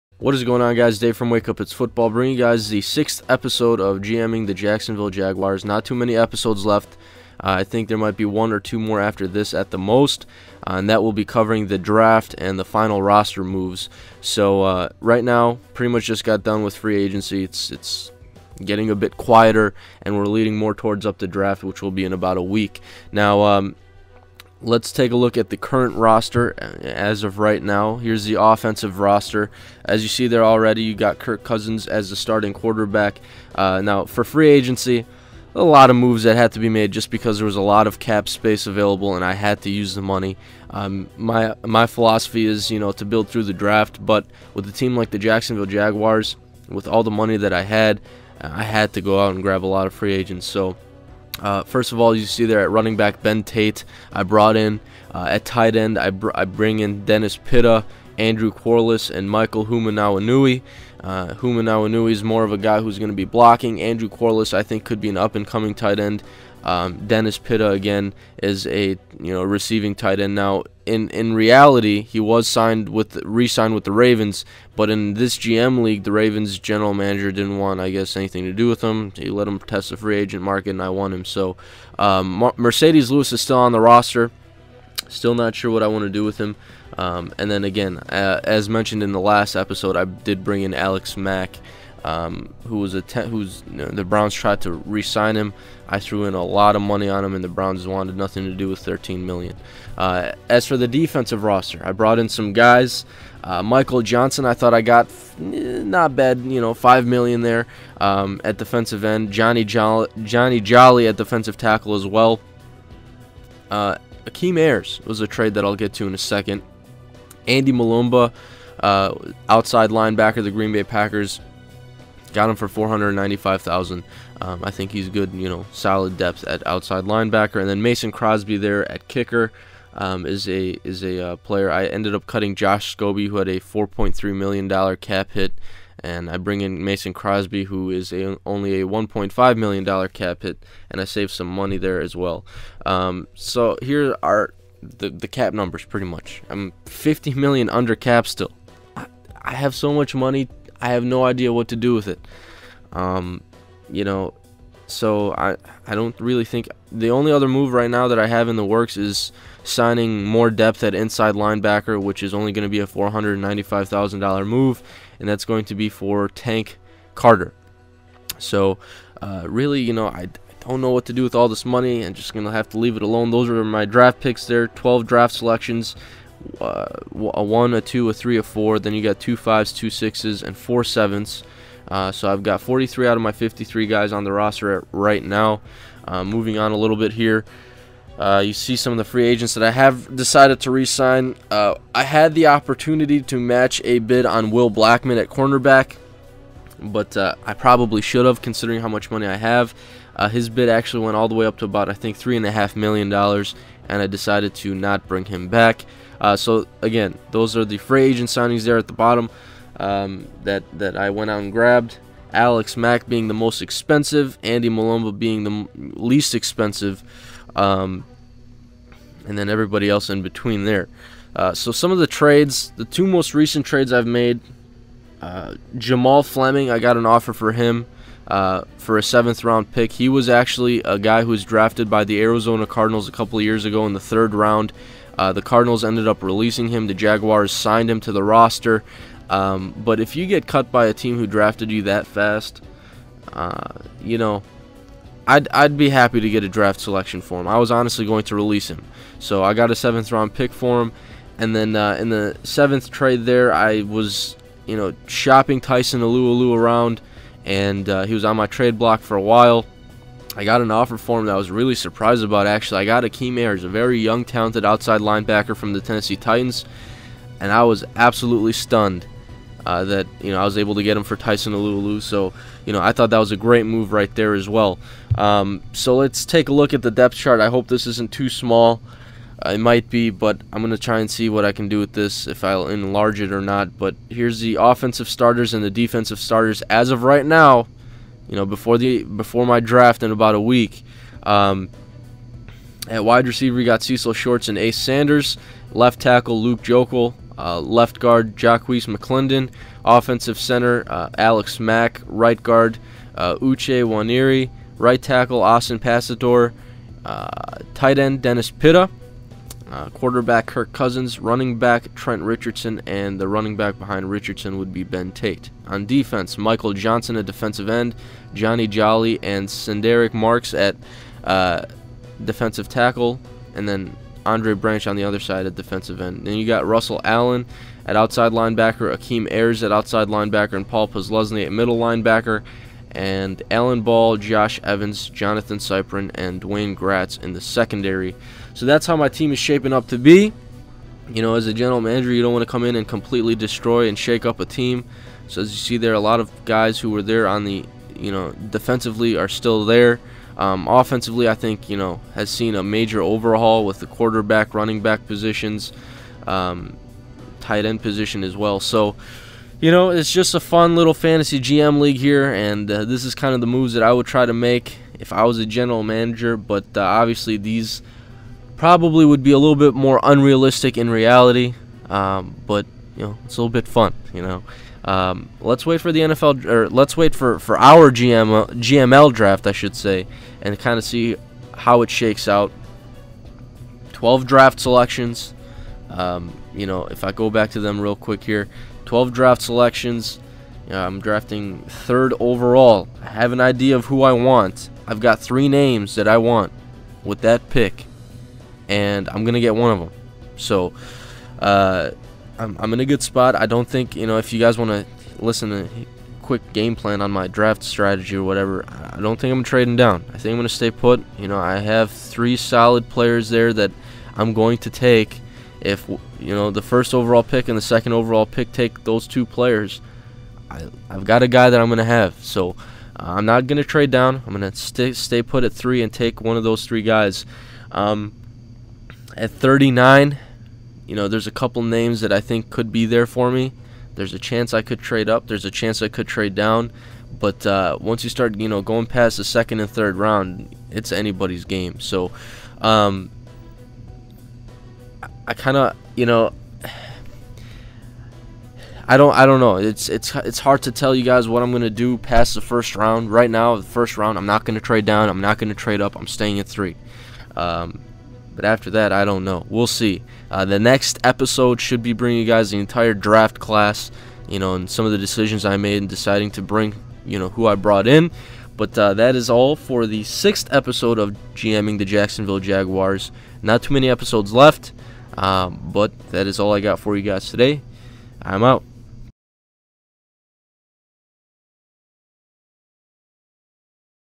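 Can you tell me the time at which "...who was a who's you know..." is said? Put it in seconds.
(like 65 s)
92 s.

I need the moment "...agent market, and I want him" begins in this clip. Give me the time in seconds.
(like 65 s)
80 s.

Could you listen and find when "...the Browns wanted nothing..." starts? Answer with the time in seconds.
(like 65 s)
97 s.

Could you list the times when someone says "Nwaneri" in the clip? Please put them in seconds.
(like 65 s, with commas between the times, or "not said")
303 s.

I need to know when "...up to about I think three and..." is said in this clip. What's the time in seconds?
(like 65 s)
201 s.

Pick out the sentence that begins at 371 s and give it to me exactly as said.
Um, but you know, it's a little bit fun.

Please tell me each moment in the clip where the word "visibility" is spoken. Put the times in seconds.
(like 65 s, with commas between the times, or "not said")
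not said.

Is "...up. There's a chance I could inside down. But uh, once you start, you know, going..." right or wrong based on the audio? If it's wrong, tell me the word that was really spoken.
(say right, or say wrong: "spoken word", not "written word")
wrong: "trade", not "inside".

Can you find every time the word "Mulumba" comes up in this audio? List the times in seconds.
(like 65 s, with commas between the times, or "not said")
117 s, 214 s.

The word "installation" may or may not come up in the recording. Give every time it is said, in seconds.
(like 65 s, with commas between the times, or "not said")
not said.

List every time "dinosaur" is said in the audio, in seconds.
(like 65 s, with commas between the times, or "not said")
not said.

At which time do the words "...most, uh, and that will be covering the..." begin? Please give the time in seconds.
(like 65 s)
9 s.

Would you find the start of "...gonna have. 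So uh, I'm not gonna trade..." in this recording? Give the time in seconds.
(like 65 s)
421 s.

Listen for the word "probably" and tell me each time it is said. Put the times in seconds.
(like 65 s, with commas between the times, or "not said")
197 s, 368 s.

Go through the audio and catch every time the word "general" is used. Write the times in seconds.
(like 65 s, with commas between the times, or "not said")
76 s, 341 s, 365 s.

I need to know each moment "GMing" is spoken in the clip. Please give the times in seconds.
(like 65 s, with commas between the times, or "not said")
4 s, 471 s.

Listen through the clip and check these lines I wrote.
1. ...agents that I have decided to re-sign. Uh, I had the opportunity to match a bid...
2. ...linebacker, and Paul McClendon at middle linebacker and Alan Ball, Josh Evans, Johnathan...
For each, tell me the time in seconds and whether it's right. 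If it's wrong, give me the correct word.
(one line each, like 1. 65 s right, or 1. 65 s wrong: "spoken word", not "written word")
1. 189 s right
2. 330 s wrong: "Posluszny", not "McClendon".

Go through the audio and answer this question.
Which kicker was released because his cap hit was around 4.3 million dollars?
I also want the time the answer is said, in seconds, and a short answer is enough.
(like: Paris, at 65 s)
Josh Scobee, at 132 s.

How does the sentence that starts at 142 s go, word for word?
Um, so here are the the cap numbers pretty much.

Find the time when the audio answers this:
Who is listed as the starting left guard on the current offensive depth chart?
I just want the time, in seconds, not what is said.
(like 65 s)
298 s.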